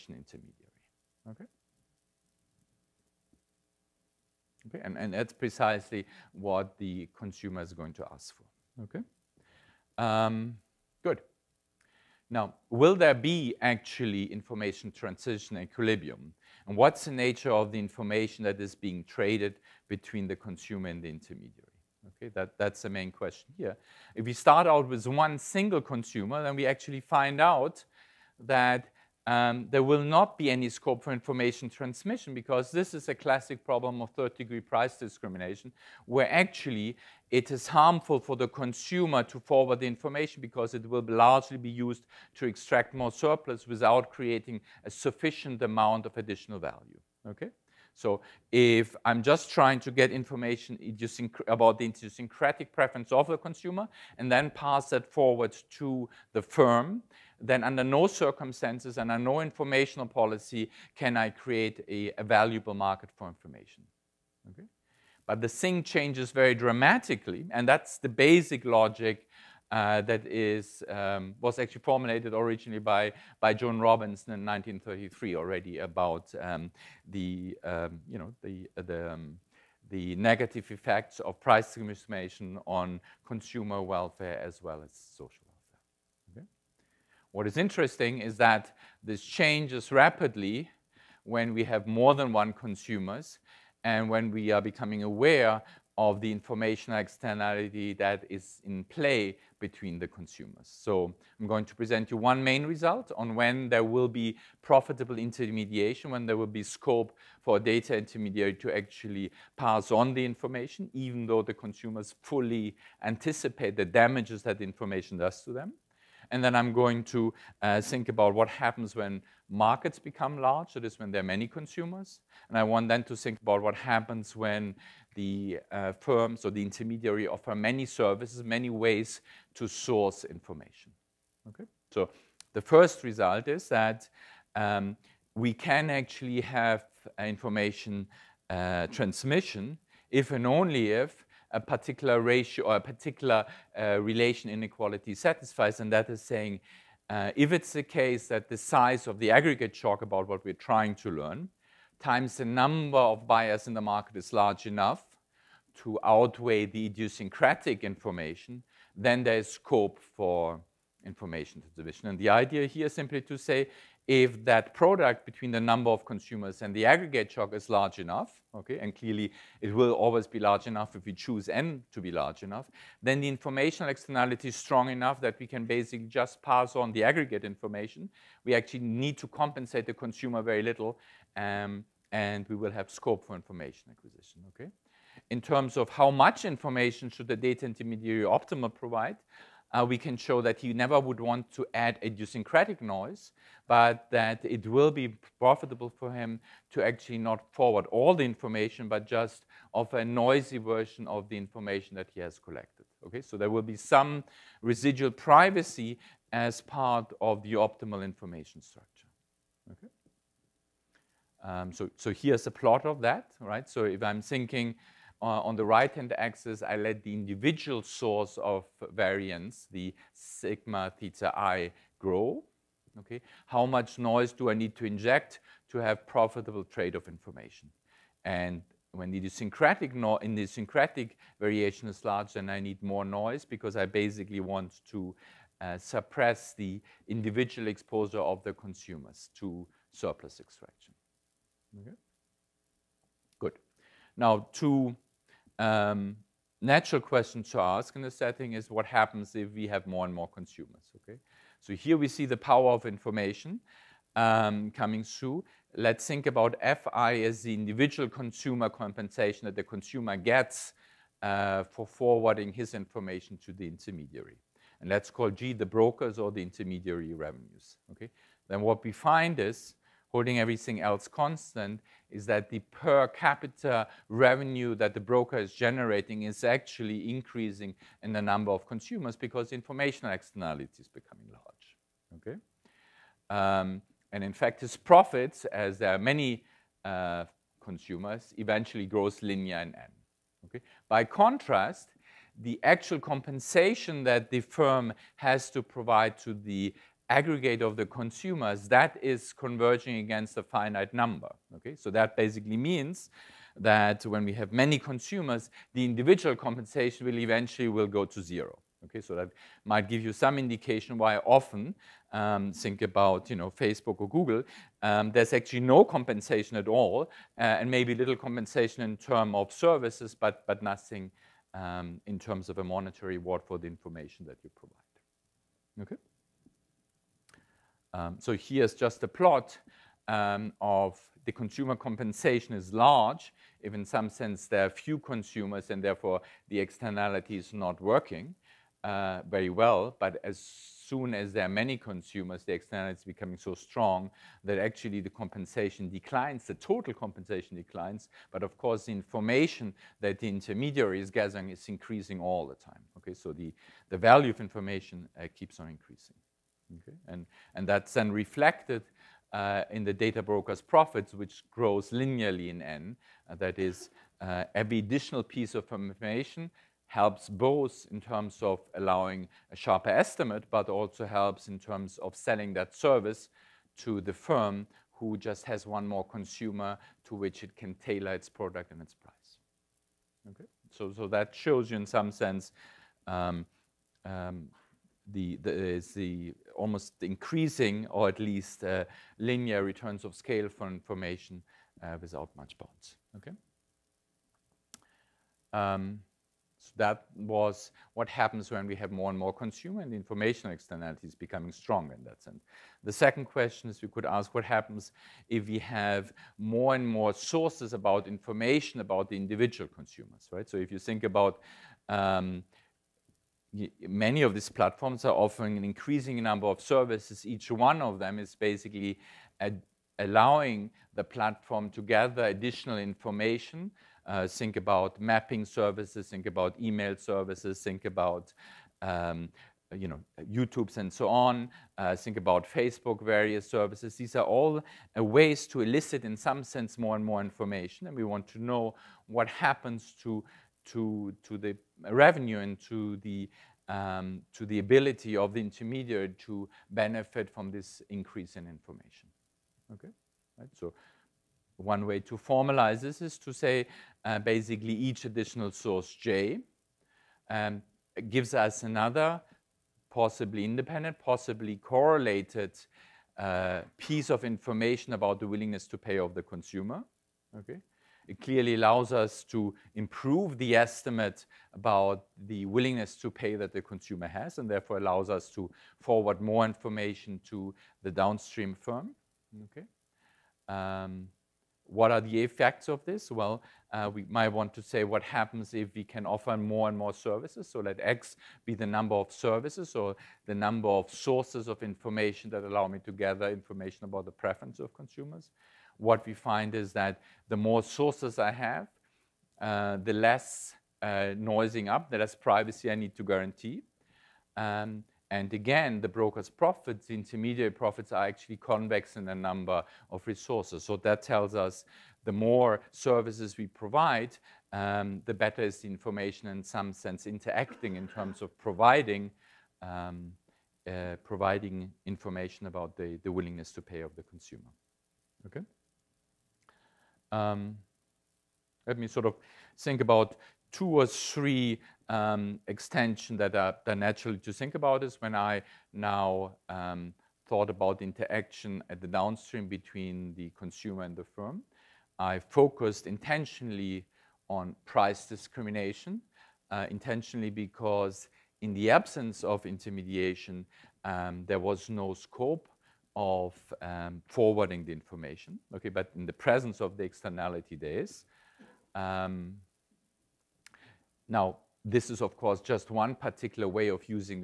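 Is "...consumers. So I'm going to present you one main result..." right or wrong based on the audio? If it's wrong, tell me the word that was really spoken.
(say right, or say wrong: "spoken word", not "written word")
right.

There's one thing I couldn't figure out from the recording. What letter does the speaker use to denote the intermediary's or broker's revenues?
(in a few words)
G.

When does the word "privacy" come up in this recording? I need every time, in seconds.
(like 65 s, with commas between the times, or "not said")
205 s, 502 s.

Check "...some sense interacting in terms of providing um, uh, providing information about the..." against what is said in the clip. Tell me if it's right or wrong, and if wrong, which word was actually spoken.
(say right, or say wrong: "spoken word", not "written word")
right.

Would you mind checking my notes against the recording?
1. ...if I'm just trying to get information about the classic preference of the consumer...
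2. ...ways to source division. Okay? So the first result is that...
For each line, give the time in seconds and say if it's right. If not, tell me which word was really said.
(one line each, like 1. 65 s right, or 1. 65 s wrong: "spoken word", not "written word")
1. 48 s wrong: "idiosyncratic", not "classic"
2. 128 s wrong: "information", not "division".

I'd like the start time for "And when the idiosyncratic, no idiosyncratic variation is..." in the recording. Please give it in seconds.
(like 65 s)
228 s.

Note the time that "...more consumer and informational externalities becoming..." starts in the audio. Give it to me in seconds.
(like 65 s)
399 s.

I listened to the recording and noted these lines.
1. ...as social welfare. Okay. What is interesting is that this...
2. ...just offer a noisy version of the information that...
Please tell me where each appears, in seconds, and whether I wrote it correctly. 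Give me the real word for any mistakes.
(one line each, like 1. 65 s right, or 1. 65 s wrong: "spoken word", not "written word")
1. 84 s right
2. 199 s right.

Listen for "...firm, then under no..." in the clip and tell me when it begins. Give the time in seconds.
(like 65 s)
56 s.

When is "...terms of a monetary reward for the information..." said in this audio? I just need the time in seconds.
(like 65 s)
322 s.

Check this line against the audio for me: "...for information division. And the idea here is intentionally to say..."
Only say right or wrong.
wrong.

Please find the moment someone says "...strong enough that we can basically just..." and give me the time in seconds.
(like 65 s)
174 s.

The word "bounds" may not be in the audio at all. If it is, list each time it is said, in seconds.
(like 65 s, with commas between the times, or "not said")
392 s.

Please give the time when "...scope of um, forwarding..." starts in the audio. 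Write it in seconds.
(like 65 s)
551 s.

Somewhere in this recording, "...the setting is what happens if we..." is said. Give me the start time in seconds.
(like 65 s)
248 s.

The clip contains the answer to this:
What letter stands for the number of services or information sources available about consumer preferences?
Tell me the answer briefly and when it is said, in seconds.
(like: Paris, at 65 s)
X, at 487 s.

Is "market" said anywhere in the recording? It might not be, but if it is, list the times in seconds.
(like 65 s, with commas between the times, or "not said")
62 s, 119 s, 153 s.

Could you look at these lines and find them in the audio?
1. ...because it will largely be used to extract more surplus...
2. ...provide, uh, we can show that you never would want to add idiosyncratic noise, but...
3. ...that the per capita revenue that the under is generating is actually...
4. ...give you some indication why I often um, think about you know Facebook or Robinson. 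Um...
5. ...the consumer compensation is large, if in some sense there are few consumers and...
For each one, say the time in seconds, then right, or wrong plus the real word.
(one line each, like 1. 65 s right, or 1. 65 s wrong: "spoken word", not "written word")
1. 40 s right
2. 188 s right
3. 272 s wrong: "broker", not "under"
4. 309 s wrong: "Google", not "Robinson"
5. 331 s right.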